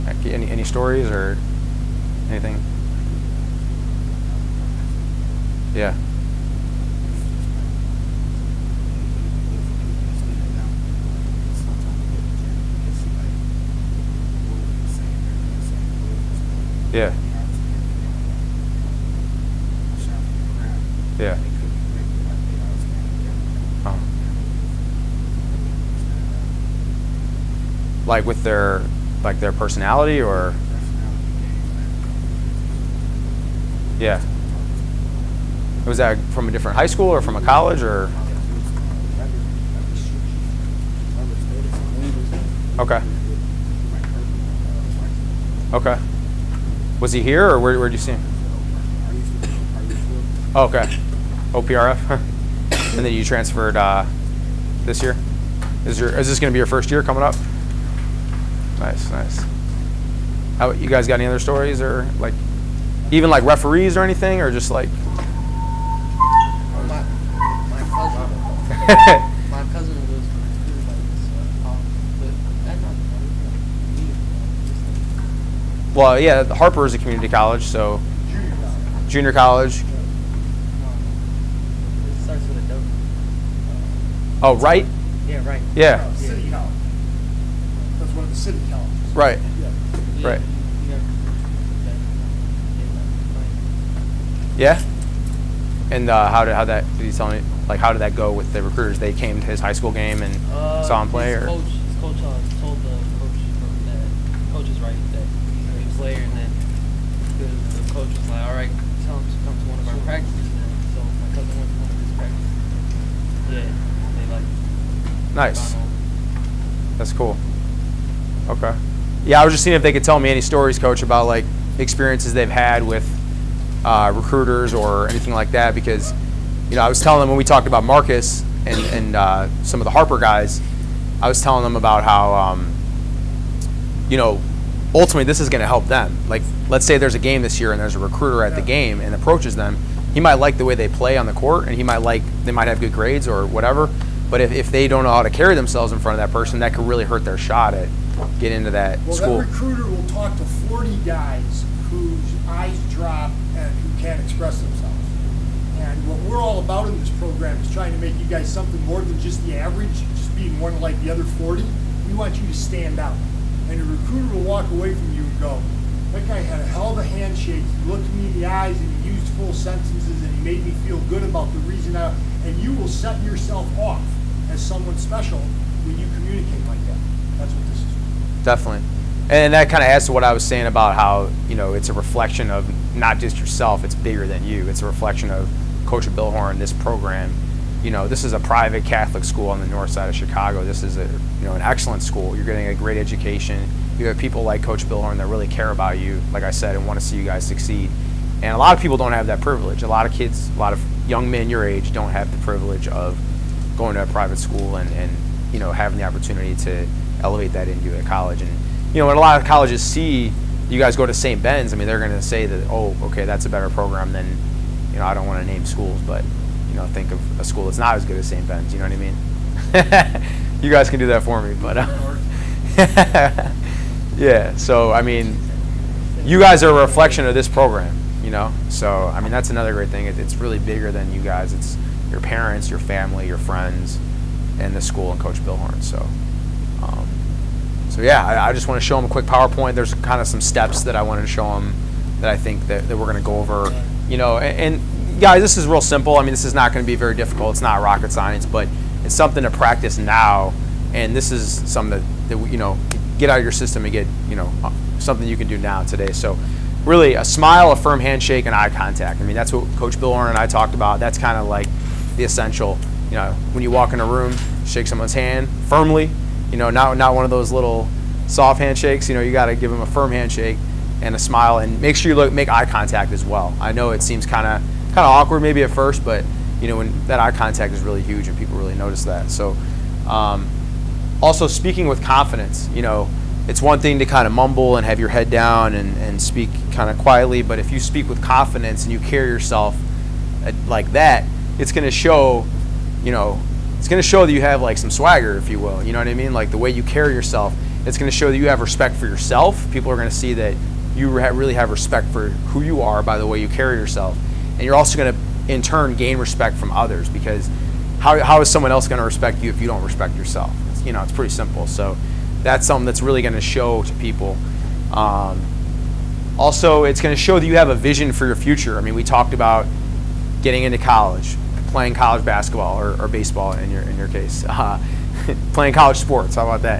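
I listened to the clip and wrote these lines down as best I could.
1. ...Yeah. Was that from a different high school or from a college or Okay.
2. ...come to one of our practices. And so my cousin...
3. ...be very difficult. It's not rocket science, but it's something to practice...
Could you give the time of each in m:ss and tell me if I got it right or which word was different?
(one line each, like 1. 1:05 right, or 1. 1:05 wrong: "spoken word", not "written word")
1. 0:33 right
2. 1:49 right
3. 4:06 right.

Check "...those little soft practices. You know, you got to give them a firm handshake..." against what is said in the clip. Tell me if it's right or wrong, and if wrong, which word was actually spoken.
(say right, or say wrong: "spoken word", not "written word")
wrong: "handshakes", not "practices".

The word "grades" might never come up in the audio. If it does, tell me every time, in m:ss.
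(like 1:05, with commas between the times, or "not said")
2:22.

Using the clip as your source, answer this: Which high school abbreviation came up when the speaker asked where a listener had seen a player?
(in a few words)
OPRF.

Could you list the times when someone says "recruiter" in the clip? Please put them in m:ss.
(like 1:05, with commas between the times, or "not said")
1:38, 2:04, 2:17, 2:29, 2:43.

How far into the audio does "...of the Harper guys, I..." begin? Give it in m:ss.
2:09.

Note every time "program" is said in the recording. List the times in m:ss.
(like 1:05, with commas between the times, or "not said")
2:37, 3:06, 3:33, 3:47.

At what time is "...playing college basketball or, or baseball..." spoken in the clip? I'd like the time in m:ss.
5:21.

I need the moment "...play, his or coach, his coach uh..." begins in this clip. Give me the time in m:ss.
1:41.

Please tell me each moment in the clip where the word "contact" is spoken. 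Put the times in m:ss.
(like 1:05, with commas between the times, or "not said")
4:18, 4:32, 4:37.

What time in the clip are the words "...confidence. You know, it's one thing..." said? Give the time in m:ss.
4:42.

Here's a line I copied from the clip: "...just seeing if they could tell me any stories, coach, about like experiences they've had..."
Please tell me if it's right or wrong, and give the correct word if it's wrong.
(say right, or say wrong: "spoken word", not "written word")
right.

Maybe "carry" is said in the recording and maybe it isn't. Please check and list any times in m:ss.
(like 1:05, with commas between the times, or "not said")
2:25, 4:48, 4:56, 5:03.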